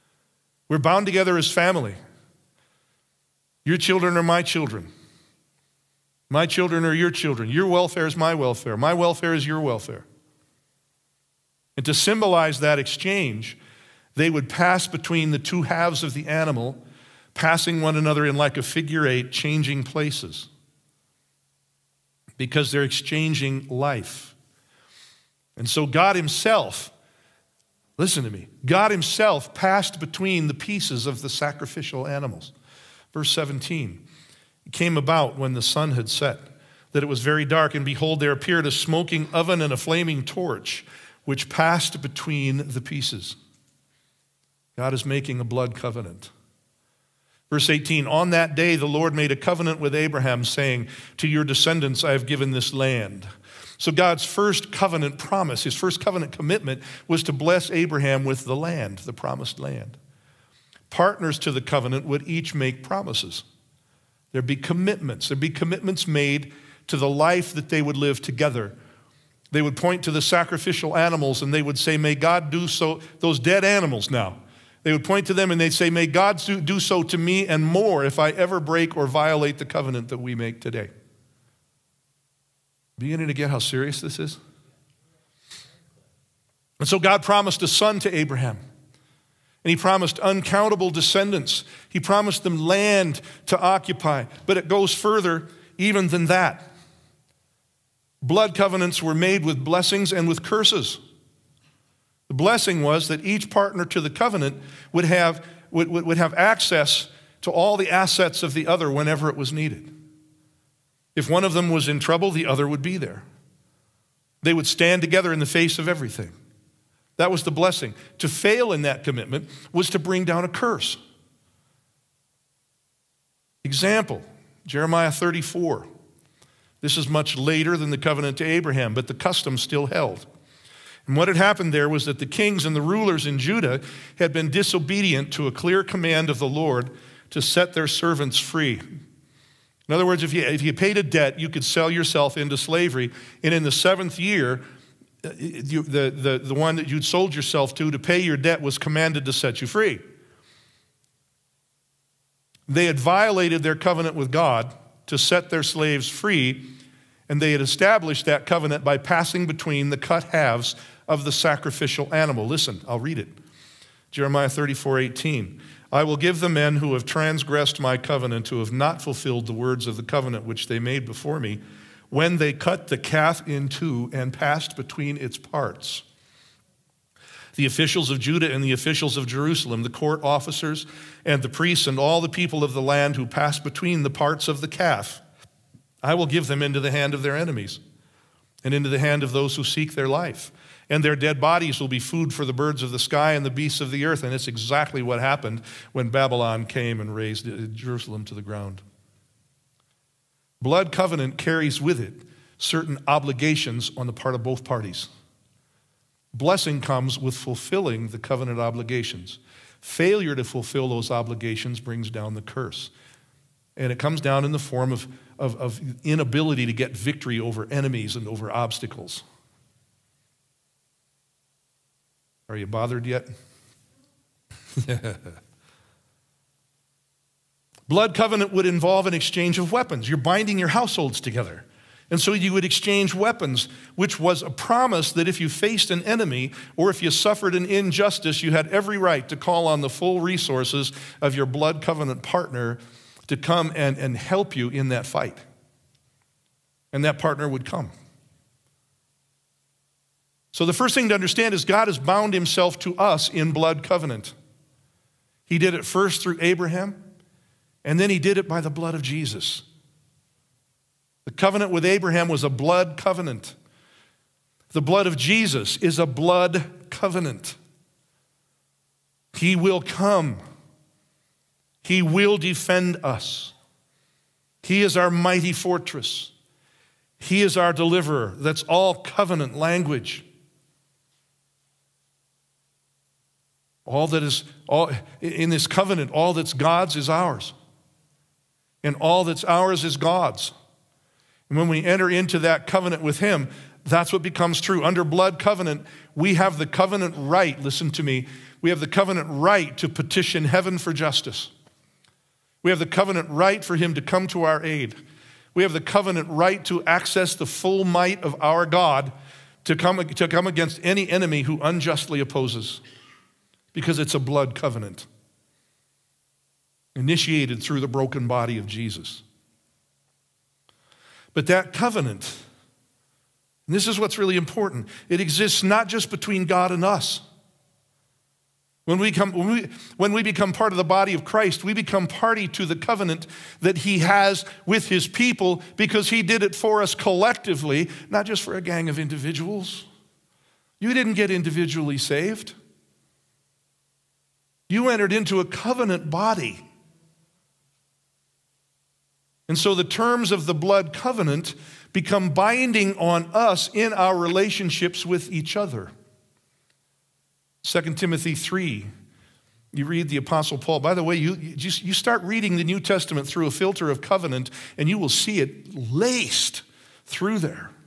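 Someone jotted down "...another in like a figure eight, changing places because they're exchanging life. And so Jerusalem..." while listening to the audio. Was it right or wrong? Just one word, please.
wrong.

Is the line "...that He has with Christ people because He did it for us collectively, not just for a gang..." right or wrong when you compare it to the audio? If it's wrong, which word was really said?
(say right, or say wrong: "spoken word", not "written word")
wrong: "His", not "Christ".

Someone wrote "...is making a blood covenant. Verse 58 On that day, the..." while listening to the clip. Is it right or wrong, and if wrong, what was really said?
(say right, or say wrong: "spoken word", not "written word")
wrong: "18", not "58".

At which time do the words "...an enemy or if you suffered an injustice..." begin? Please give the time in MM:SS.
03:55.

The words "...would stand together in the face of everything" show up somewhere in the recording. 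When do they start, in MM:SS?
01:54.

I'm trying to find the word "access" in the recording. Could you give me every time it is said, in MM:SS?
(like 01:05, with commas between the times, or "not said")
01:46, 05:06.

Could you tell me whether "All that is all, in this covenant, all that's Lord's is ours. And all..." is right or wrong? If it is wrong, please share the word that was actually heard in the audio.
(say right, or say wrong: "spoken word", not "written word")
wrong: "God", not "Lord".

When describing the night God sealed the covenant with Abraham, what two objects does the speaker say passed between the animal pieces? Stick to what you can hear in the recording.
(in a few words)
A smoking oven and a flaming torch.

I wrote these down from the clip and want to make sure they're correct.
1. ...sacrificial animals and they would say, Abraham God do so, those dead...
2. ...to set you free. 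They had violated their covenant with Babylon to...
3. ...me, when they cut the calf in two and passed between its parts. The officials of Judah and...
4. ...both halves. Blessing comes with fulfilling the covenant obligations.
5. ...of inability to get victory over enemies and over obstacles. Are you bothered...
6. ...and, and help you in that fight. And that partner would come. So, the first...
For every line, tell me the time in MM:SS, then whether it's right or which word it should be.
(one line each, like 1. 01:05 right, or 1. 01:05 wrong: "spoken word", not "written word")
1. 01:10 wrong: "May", not "Abraham"
2. 02:29 wrong: "God", not "Babylon"
3. 02:51 right
4. 03:24 wrong: "parties", not "halves"
5. 03:35 right
6. 04:03 right.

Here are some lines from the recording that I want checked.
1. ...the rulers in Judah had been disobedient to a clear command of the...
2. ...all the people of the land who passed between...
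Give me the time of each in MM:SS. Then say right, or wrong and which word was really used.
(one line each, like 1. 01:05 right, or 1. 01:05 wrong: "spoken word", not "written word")
1. 02:12 right
2. 03:01 right.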